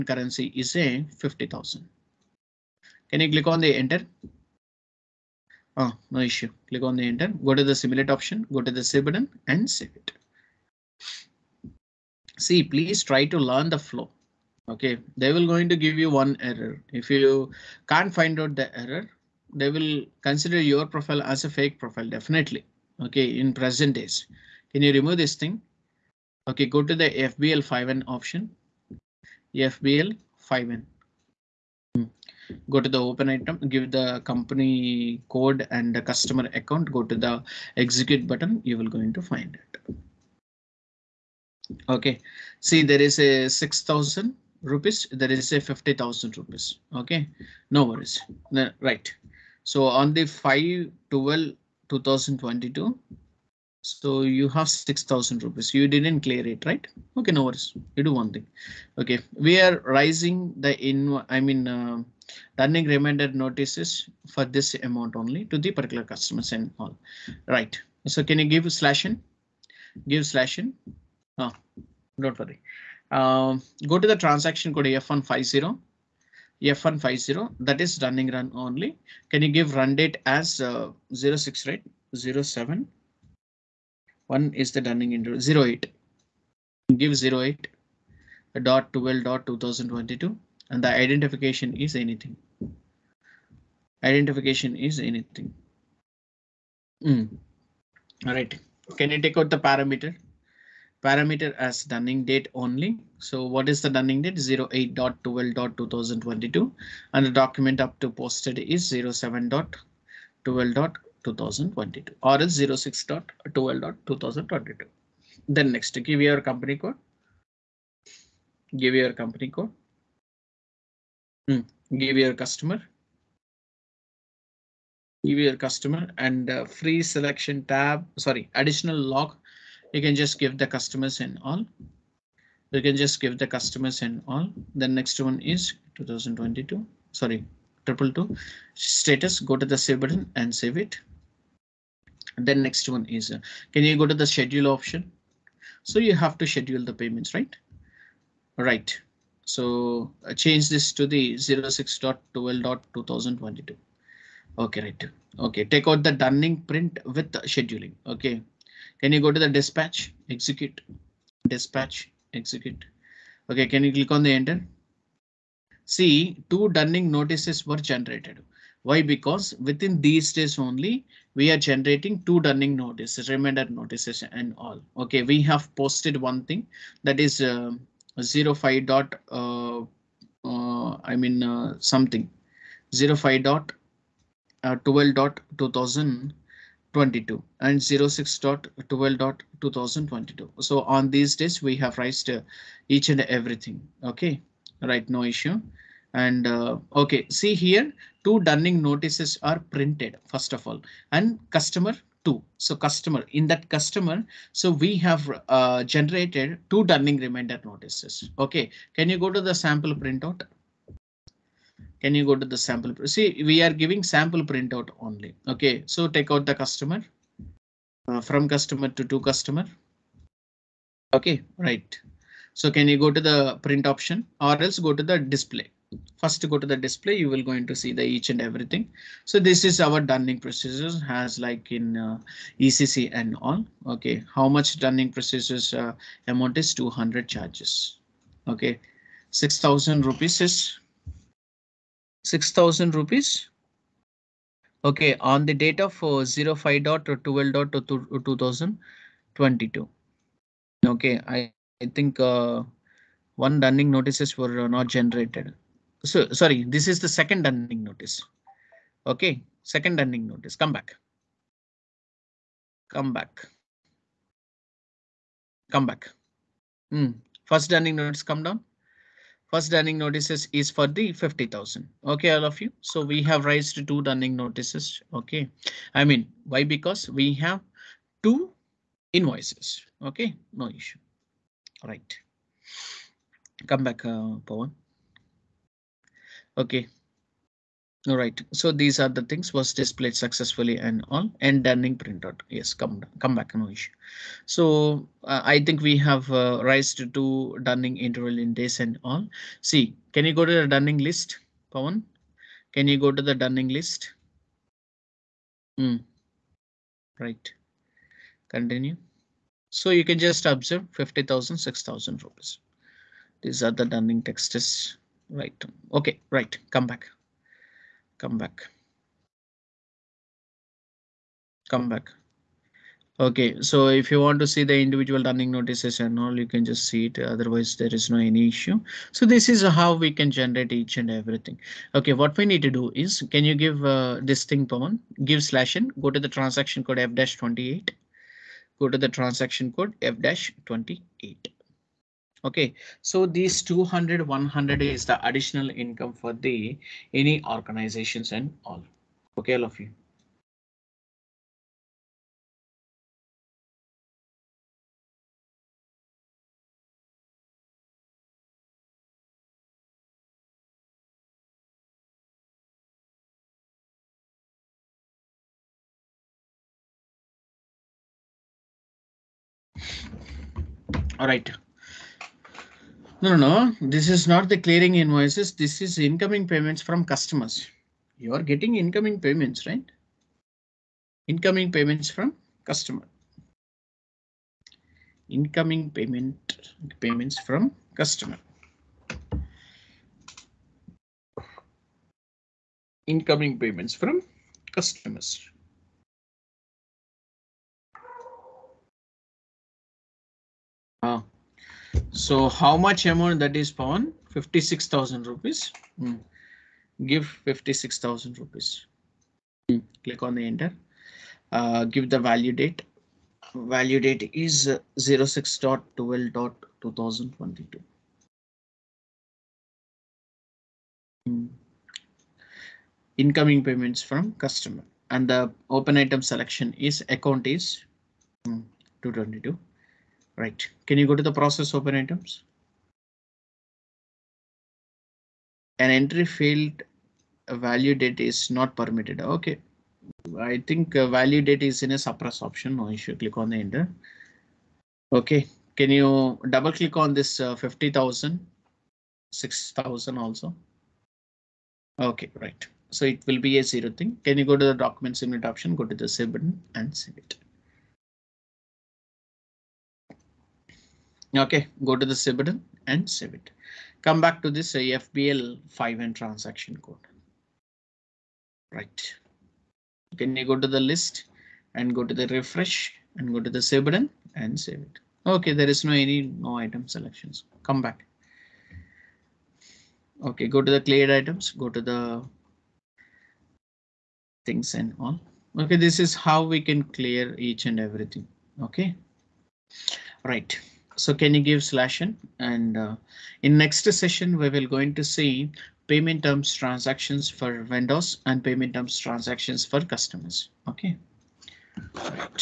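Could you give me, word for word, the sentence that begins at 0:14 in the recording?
OK, they will going to give you one error.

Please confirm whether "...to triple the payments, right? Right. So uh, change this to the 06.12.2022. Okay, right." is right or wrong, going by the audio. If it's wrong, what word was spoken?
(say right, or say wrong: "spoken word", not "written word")
wrong: "schedule", not "triple".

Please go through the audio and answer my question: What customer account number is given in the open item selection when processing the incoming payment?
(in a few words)
222.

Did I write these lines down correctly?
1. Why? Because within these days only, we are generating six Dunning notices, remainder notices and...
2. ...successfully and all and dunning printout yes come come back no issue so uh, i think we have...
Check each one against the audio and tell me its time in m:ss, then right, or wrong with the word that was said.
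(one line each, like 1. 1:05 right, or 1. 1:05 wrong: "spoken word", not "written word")
1. 2:48 wrong: "two", not "six"
2. 4:50 right.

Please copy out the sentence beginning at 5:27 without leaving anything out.
Otherwise, there is no any issue.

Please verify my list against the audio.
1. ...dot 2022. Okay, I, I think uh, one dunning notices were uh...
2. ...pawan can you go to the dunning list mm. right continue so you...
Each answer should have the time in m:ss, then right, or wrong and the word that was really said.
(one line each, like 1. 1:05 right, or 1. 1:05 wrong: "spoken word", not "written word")
1. 4:07 right
2. 5:01 right.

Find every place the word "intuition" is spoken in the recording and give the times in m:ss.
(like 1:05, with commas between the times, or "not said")
not said.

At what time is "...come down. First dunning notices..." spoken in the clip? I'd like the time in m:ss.
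4:28.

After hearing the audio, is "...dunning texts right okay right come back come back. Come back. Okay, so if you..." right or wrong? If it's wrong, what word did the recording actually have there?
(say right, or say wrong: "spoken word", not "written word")
right.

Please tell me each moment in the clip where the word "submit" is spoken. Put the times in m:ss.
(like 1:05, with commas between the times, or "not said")
7:35.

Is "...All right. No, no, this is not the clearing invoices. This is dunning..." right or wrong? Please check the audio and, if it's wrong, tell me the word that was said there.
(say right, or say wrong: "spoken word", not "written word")
wrong: "incoming", not "dunning".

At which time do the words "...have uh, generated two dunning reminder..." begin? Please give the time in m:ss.
3:24.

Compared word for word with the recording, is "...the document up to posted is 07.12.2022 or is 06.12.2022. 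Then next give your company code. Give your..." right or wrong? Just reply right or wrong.
right.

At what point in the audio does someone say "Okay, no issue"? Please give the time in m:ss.
4:40.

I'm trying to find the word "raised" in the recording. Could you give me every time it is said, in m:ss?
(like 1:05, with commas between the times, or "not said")
3:11, 4:33, 4:56.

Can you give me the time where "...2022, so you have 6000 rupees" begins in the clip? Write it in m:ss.
0:51.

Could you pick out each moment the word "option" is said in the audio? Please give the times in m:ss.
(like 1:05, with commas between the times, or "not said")
0:08, 0:28, 2:24, 3:43, 7:22, 7:35.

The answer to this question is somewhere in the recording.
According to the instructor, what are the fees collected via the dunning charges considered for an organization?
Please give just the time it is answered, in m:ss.
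5:45.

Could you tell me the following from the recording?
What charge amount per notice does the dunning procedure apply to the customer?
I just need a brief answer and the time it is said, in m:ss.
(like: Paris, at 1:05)
200, at 3:56.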